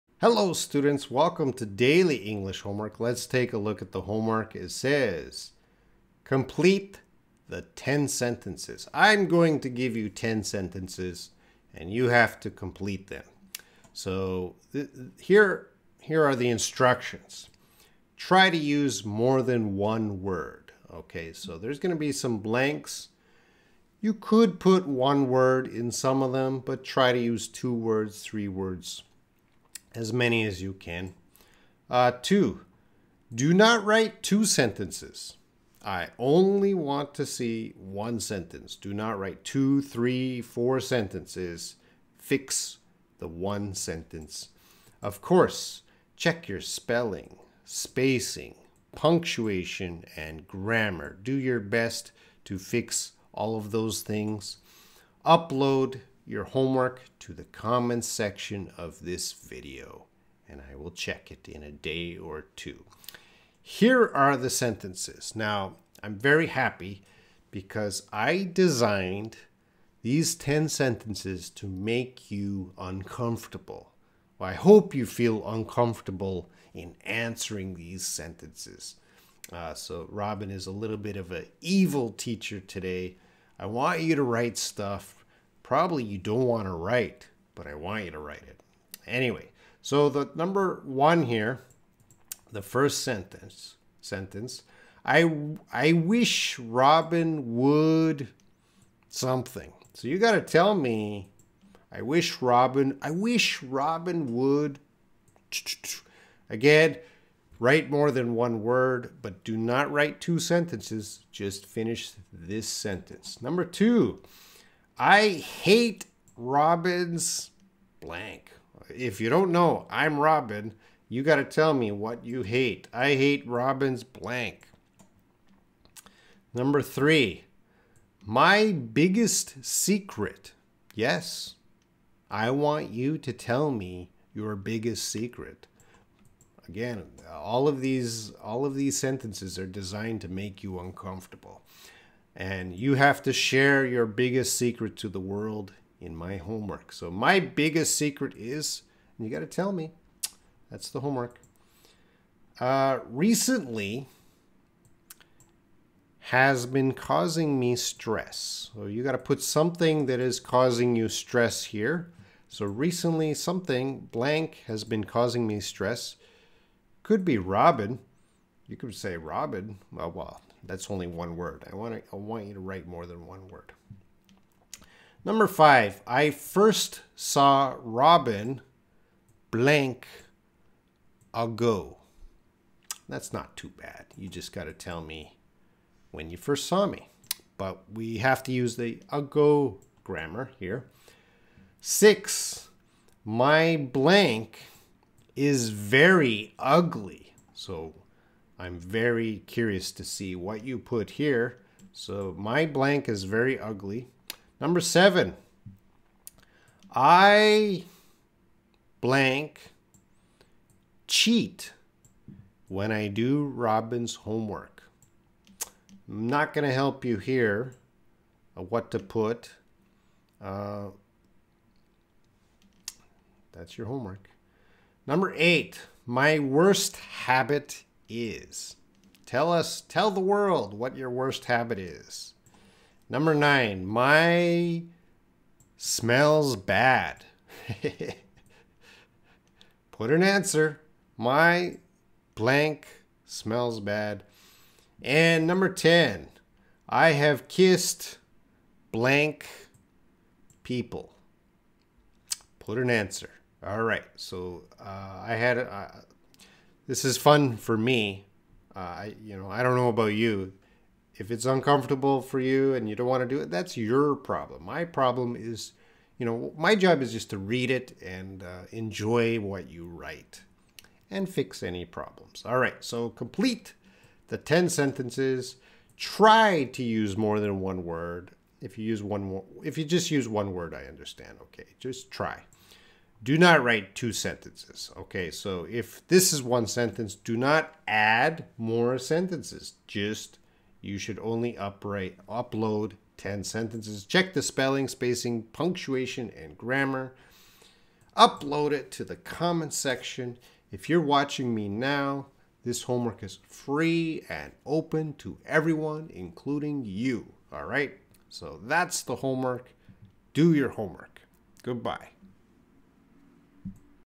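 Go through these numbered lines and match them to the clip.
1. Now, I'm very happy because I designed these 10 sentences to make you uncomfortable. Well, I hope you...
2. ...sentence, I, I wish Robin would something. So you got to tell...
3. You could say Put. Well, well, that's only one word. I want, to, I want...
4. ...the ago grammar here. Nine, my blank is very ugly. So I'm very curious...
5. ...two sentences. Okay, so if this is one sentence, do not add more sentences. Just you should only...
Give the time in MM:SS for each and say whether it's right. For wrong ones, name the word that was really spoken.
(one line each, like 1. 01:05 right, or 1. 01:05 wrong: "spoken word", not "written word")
1. 01:05 right
2. 01:34 right
3. 02:48 wrong: "Robin", not "Put"
4. 03:08 wrong: "Six", not "Nine"
5. 04:43 right.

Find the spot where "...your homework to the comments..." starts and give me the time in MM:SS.
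00:56.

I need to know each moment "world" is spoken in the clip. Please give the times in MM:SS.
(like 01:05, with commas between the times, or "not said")
02:25, 03:50.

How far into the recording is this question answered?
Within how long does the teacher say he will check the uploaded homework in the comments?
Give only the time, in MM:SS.
01:01.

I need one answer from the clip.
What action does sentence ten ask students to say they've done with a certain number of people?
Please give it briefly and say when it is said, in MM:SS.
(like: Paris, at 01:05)
kissed, at 04:06.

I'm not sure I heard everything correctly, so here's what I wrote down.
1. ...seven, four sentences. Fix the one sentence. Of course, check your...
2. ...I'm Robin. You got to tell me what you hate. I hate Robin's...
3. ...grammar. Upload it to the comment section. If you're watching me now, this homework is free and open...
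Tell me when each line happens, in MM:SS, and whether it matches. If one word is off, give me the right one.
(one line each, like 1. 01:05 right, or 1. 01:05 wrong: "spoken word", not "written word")
1. 00:39 wrong: "three", not "seven"
2. 01:59 right
3. 04:56 right.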